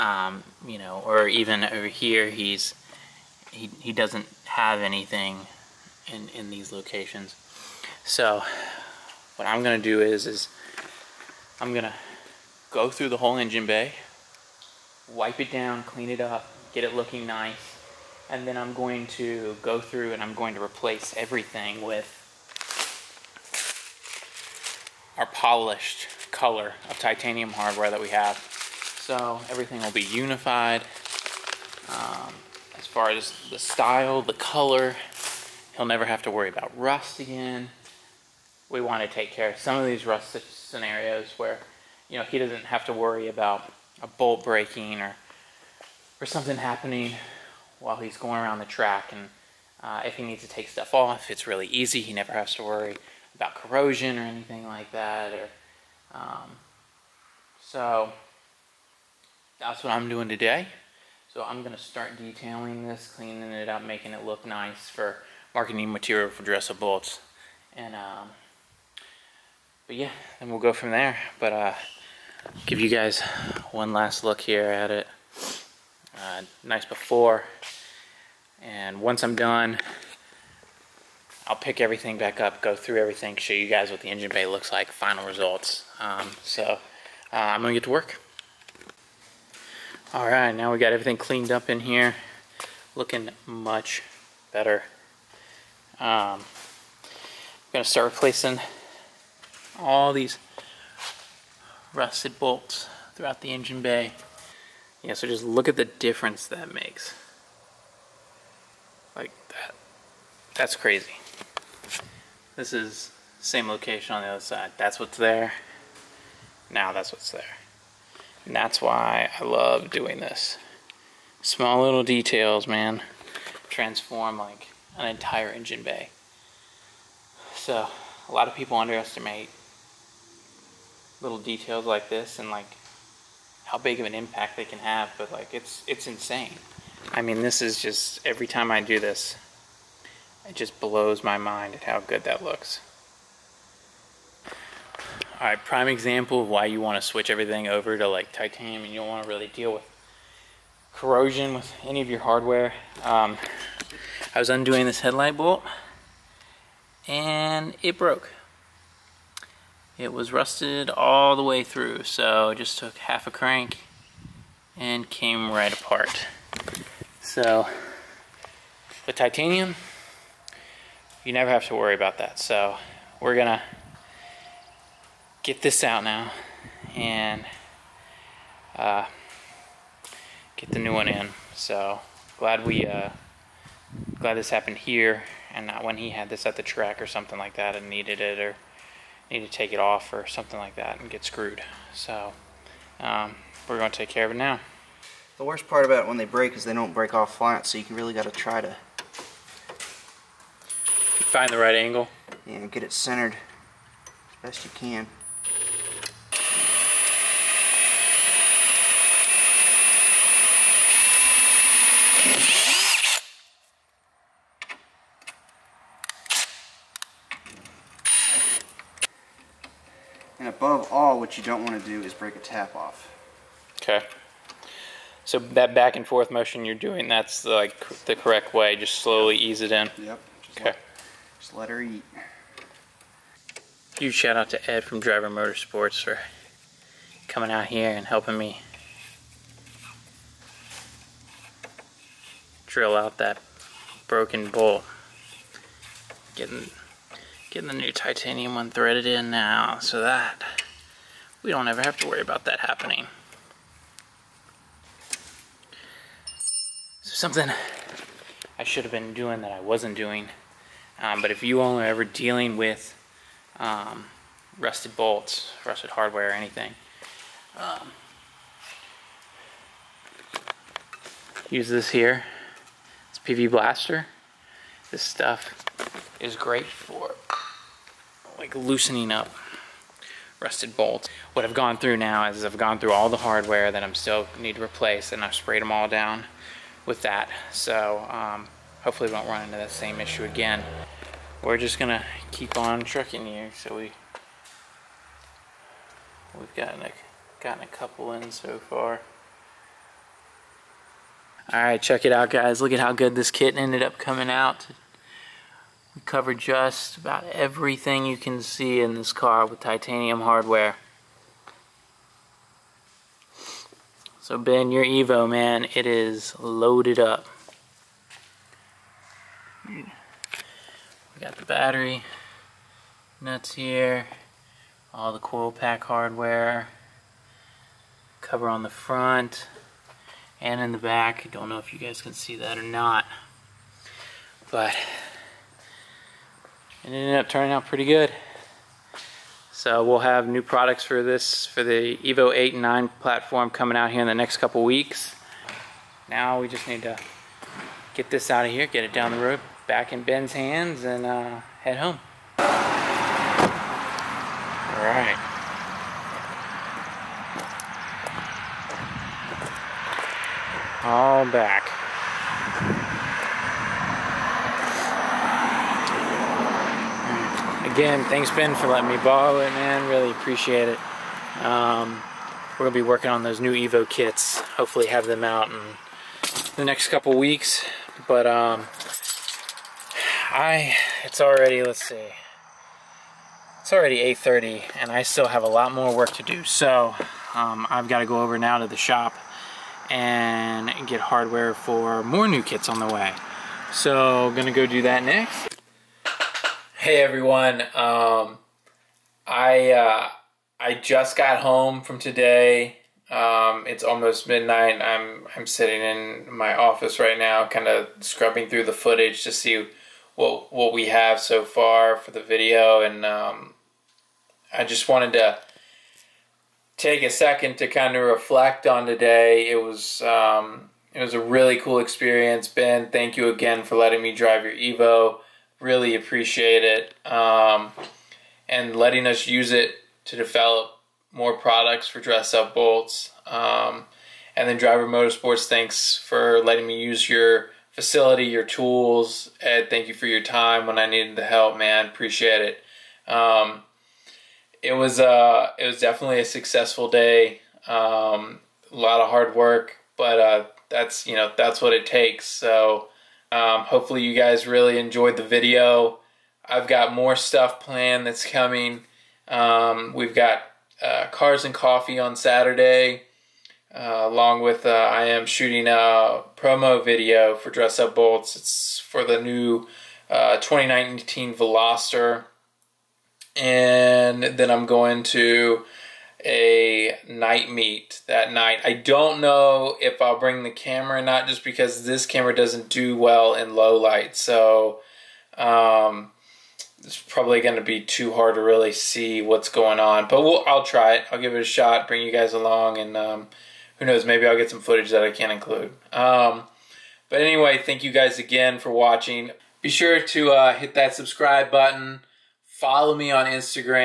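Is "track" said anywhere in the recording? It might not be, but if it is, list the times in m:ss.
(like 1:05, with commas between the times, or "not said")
0:48, 3:06.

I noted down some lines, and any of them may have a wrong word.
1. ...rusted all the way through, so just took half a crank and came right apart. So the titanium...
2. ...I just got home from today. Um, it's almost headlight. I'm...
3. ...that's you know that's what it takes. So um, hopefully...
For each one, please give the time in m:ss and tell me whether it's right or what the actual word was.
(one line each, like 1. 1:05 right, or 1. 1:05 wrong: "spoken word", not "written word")
1. 2:40 right
2. 6:40 wrong: "midnight", not "headlight"
3. 7:30 right.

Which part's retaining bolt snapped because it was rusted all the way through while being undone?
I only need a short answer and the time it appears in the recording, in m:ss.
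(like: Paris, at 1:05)
Headlight, at 2:35.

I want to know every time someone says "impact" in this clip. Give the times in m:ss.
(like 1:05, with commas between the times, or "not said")
2:14.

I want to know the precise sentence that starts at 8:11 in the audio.
I'll give it a shot, bring you guys along, and um, who knows, maybe I'll get some footage that I can include.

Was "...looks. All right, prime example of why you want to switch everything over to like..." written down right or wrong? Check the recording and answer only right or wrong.
right.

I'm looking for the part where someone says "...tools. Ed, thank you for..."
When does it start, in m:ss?
7:18.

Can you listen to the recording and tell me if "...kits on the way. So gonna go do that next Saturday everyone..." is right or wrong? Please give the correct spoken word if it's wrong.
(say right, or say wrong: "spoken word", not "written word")
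wrong: "Hey", not "Saturday".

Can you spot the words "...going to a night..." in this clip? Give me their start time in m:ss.
7:54.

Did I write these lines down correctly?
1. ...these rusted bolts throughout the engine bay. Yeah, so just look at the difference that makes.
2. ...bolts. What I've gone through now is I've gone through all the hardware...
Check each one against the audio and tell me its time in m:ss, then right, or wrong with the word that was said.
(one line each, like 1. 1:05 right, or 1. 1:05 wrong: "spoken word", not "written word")
1. 1:40 right
2. 4:40 right.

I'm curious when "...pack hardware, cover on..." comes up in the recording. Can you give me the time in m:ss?
5:25.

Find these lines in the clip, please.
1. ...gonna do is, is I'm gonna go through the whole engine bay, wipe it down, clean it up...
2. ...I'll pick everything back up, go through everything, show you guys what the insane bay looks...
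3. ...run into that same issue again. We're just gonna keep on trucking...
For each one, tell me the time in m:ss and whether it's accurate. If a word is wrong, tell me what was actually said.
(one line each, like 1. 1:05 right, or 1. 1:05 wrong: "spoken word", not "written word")
1. 0:09 right
2. 1:21 wrong: "engine", not "insane"
3. 4:49 right.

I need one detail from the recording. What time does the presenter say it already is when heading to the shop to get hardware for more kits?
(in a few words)
8:30.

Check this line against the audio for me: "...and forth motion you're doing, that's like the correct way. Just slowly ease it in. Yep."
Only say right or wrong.
right.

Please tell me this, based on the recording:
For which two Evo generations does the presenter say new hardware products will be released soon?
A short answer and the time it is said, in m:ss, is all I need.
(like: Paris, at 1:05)
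Evo 8 and 9, at 5:41.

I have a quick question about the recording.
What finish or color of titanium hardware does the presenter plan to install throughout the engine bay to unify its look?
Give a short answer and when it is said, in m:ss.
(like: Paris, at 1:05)
Polished, at 0:25.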